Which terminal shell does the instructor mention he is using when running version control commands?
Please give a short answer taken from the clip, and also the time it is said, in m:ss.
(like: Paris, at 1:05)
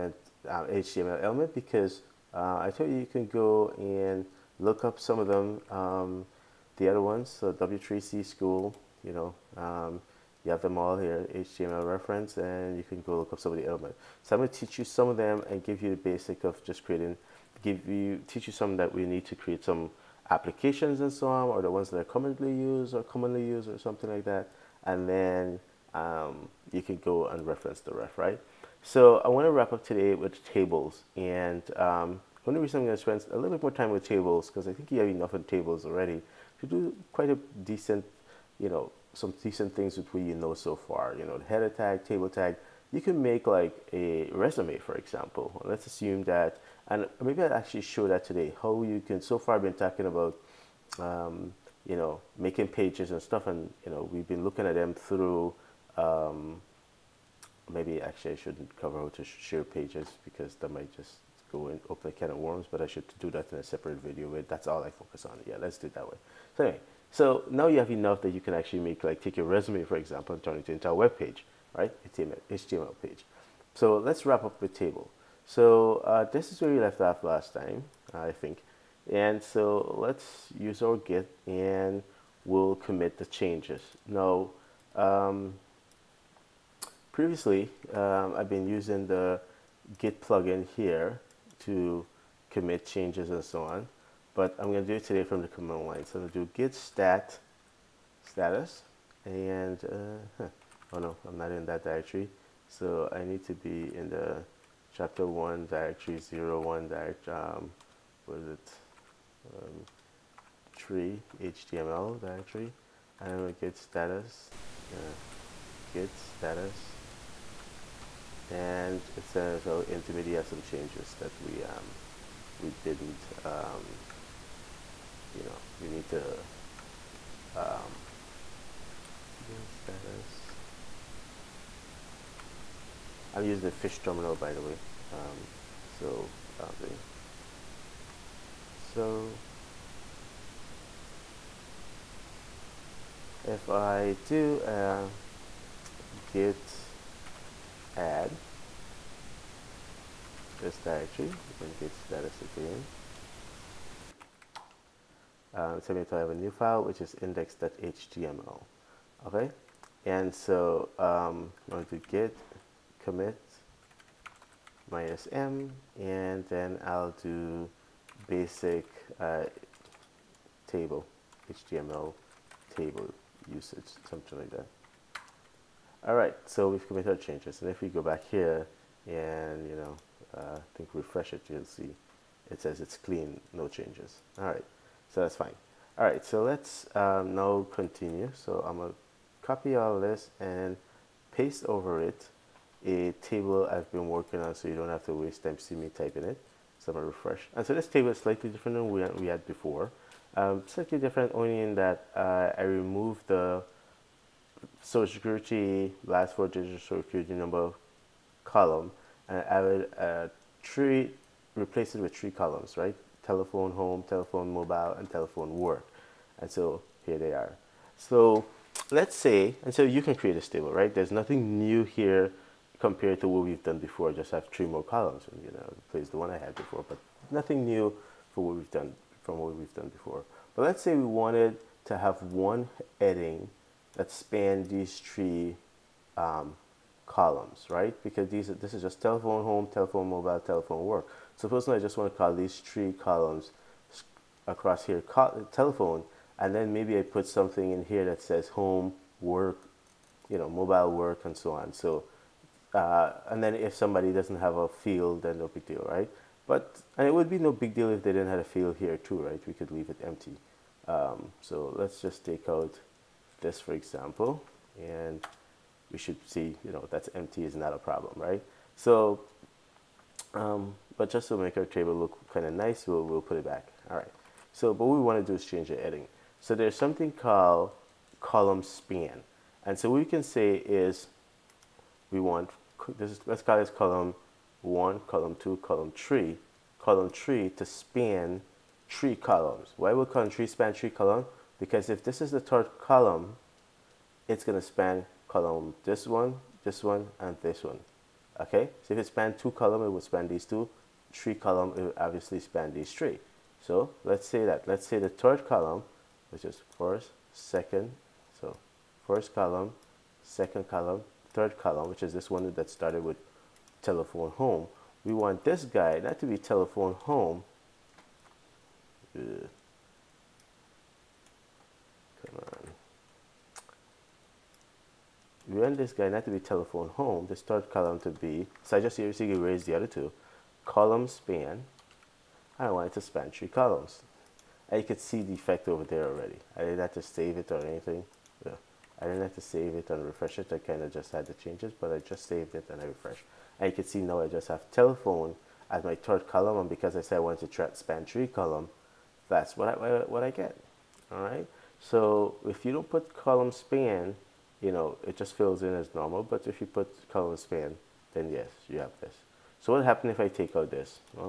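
Fish, at 2:13.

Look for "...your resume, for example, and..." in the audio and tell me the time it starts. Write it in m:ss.
1:09.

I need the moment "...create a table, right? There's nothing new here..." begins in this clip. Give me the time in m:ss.
3:40.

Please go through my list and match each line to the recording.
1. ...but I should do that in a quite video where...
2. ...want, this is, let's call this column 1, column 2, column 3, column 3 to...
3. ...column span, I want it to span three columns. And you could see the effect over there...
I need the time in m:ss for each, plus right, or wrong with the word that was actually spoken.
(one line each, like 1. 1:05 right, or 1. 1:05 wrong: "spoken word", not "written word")
1. 1:02 wrong: "separate", not "quite"
2. 4:42 right
3. 5:30 right.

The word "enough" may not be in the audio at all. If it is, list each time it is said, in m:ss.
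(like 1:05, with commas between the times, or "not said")
0:35, 1:07.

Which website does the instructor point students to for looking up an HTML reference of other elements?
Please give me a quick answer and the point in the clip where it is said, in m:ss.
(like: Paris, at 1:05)
W3C School, at 0:07.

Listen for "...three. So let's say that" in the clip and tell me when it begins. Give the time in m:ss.
5:02.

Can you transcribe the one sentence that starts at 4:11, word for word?
So, uh, and then if somebody doesn't have a field, then no big deal, right?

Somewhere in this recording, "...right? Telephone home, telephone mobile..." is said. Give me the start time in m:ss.
3:32.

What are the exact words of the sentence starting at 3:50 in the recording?
But let's say we wanted to have one heading that span these three um, columns, right?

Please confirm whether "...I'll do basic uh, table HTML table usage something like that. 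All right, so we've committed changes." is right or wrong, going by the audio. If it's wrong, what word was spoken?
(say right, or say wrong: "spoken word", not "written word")
right.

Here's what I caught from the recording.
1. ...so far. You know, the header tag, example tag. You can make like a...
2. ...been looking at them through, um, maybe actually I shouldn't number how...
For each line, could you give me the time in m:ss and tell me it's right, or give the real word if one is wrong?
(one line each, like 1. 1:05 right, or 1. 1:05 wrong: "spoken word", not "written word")
1. 0:40 wrong: "table", not "example"
2. 0:54 wrong: "cover", not "number".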